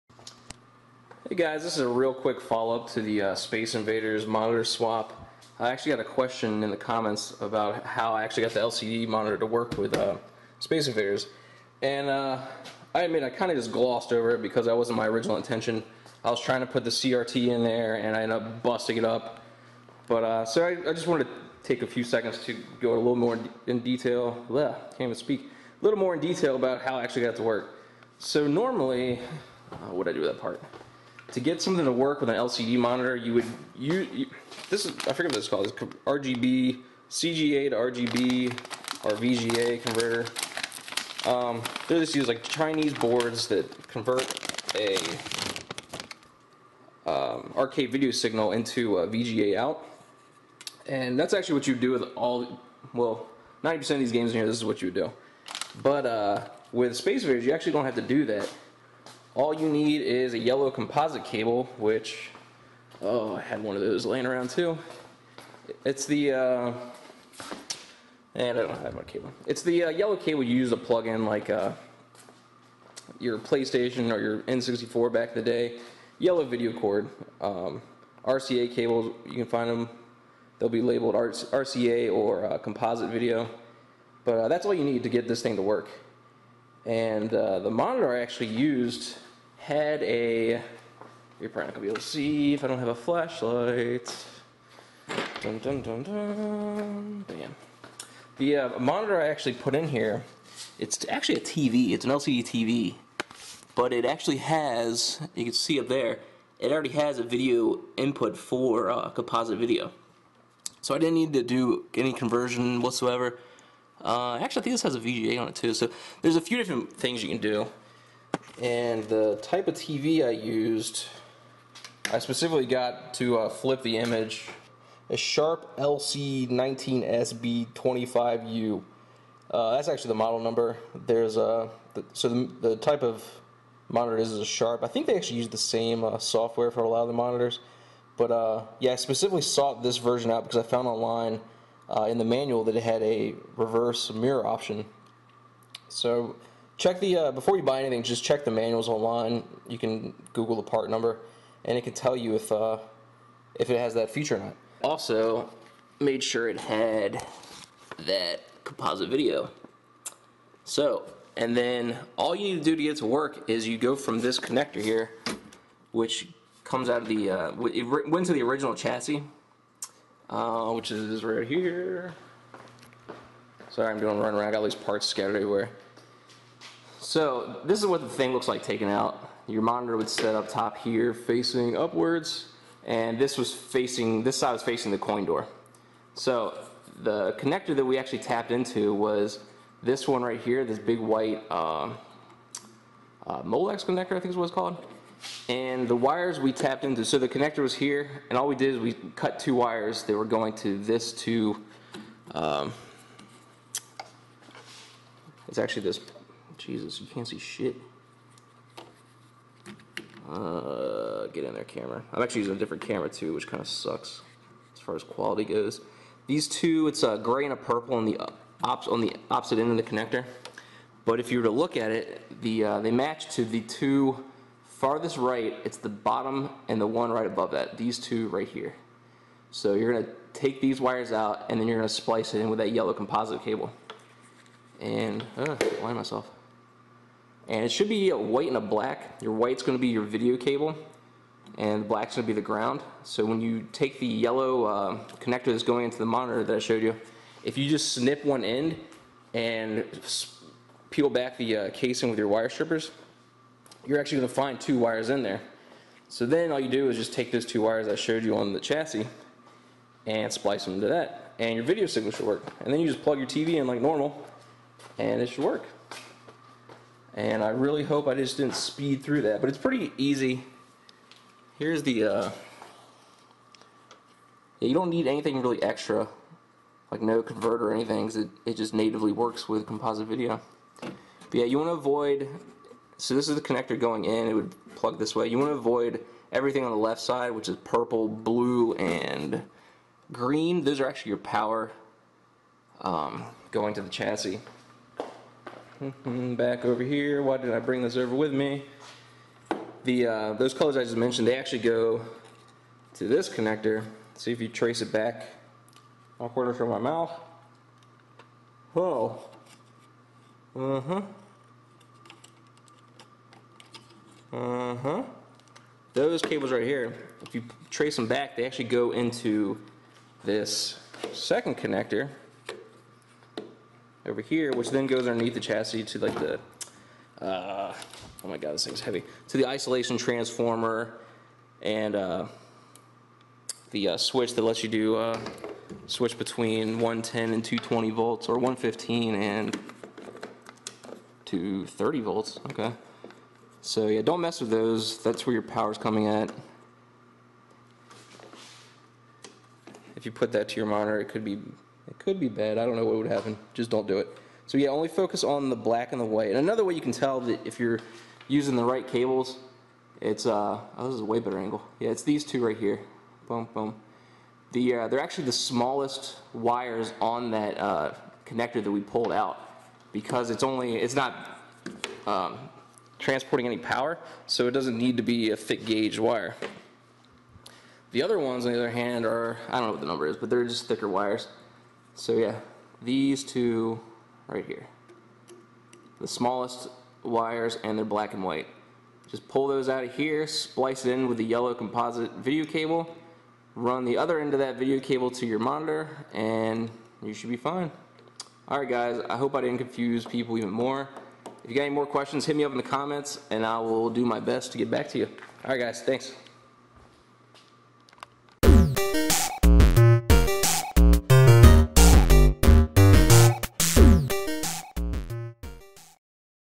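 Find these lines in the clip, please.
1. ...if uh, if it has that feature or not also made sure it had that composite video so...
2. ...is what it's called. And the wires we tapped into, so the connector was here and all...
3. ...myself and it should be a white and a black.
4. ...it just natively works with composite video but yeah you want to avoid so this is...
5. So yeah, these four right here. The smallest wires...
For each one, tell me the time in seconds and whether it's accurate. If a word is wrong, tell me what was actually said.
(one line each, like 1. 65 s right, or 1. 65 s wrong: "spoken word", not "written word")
1. 152 s right
2. 194 s right
3. 235 s right
4. 278 s right
5. 382 s wrong: "two", not "four".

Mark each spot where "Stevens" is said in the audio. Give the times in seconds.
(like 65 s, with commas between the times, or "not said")
not said.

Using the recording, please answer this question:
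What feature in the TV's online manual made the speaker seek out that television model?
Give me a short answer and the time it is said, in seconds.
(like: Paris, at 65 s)
reverse mirror option, at 143 s.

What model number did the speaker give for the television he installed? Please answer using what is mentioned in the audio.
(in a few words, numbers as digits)
LC19SB25U.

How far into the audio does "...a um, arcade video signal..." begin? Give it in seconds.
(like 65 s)
44 s.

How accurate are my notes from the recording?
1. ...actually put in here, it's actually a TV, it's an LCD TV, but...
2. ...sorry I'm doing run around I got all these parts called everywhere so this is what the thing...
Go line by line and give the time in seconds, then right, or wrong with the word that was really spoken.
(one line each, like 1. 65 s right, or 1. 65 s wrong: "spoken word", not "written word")
1. 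99 s right
2. 173 s wrong: "scattered", not "called".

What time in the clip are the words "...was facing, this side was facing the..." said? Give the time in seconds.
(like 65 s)
183 s.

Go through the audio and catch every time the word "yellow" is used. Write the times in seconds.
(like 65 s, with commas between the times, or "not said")
60 s, 69 s, 76 s, 232 s, 244 s, 391 s.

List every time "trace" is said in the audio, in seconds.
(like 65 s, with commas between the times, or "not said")
304 s, 317 s.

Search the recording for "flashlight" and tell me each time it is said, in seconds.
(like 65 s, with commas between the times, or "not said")
92 s.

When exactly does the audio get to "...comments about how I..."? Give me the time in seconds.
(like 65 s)
6 s.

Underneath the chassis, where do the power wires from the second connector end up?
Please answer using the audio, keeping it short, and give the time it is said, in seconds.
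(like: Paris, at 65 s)
isolation transformer, at 329 s.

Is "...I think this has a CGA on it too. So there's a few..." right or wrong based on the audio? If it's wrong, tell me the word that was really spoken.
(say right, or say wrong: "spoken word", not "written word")
wrong: "VGA", not "CGA".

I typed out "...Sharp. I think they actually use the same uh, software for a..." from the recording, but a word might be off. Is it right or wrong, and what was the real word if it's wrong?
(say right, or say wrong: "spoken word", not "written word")
right.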